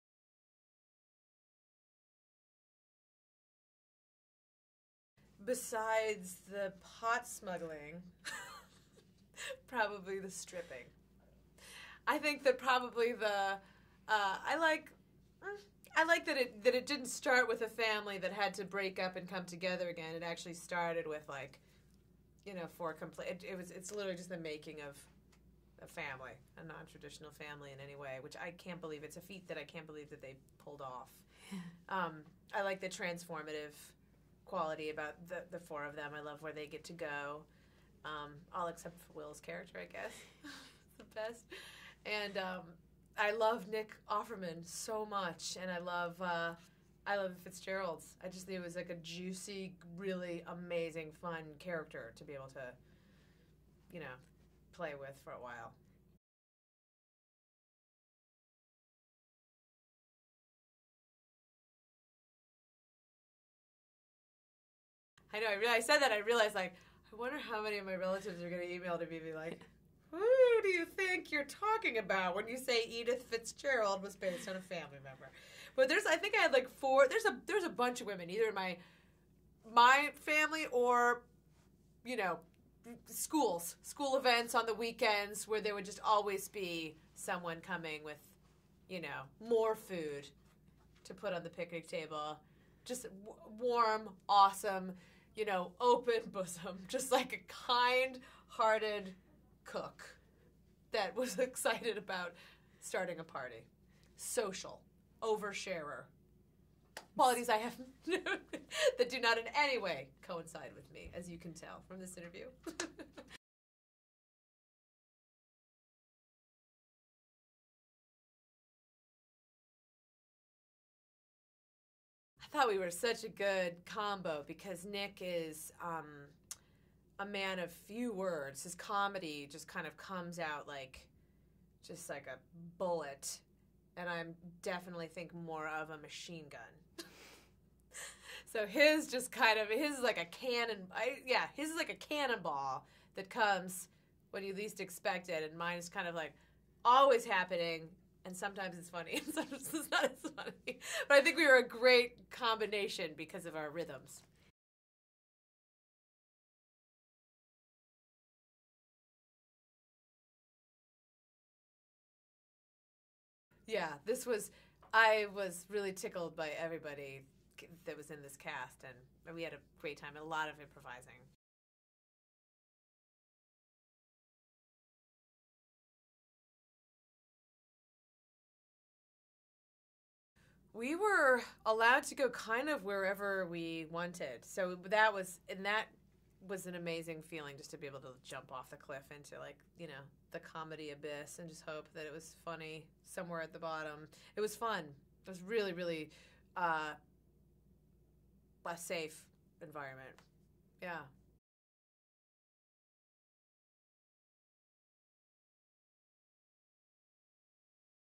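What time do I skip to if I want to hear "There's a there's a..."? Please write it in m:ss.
1:17.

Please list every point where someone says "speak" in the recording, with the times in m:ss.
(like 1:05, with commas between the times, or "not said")
not said.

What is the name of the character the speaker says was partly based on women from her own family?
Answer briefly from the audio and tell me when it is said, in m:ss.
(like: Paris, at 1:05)
Edie Fitzgerald, at 1:12.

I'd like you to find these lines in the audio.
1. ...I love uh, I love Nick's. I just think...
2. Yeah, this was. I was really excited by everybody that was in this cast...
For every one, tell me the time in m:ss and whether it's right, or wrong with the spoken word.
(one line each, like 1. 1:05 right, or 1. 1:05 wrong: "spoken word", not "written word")
1. 0:45 wrong: "Fitzgerald", not "Nick"
2. 2:43 wrong: "tickled", not "excited".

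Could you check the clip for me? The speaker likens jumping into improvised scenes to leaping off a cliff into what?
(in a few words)
the comedy abyss.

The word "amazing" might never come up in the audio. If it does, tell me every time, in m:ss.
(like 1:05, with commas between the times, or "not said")
0:50, 3:06.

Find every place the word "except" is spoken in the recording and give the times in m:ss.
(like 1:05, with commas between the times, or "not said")
0:38.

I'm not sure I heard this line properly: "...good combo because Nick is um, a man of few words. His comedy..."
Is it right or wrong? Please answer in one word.
right.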